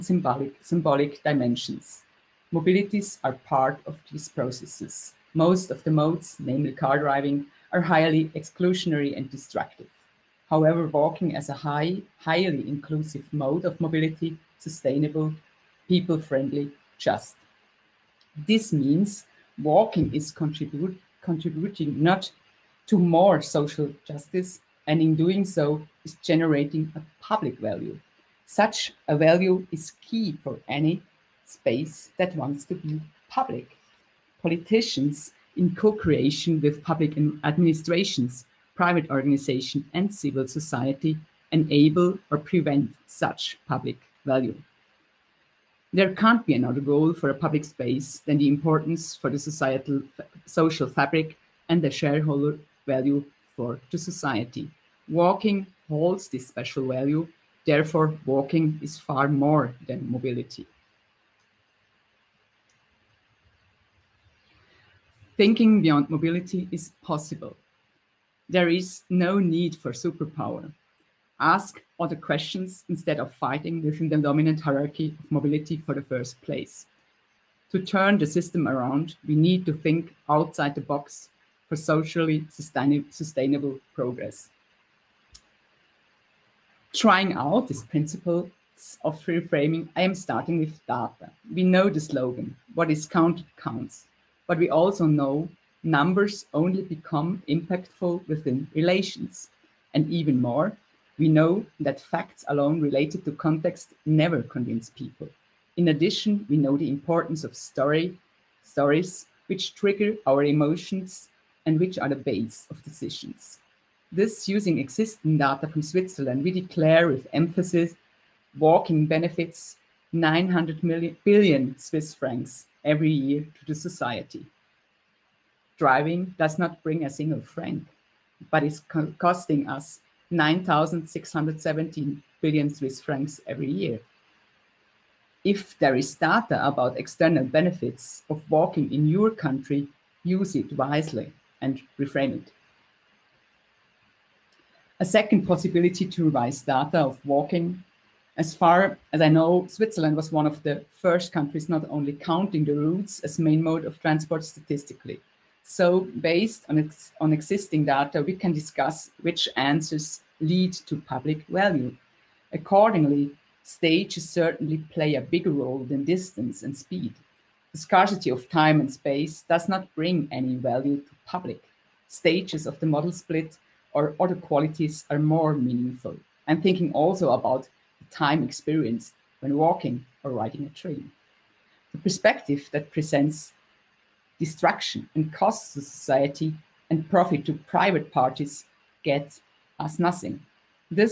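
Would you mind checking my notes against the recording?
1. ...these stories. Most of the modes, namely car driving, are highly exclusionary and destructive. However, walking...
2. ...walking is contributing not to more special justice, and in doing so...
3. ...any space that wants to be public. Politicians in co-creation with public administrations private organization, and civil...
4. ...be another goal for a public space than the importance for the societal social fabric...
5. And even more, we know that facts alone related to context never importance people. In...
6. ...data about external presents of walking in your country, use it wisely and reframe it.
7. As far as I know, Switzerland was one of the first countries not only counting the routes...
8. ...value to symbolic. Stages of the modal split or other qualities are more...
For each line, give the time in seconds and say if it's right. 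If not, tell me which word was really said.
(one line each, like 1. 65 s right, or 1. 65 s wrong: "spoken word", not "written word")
1. 4 s wrong: "processes", not "stories"
2. 19 s wrong: "social", not "special"
3. 30 s right
4. 46 s right
5. 99 s wrong: "convince", not "importance"
6. 136 s wrong: "benefits", not "presents"
7. 148 s right
8. 170 s wrong: "public", not "symbolic".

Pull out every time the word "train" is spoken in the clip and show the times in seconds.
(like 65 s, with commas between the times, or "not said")
180 s.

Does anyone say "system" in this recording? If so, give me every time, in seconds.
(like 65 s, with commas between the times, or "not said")
78 s.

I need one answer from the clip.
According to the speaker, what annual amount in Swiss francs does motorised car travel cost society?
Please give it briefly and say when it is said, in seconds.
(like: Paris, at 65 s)
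9,617 billion Swiss francs, at 130 s.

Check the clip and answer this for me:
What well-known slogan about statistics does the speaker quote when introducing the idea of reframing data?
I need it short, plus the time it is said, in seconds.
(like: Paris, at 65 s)
What is counted counts, at 92 s.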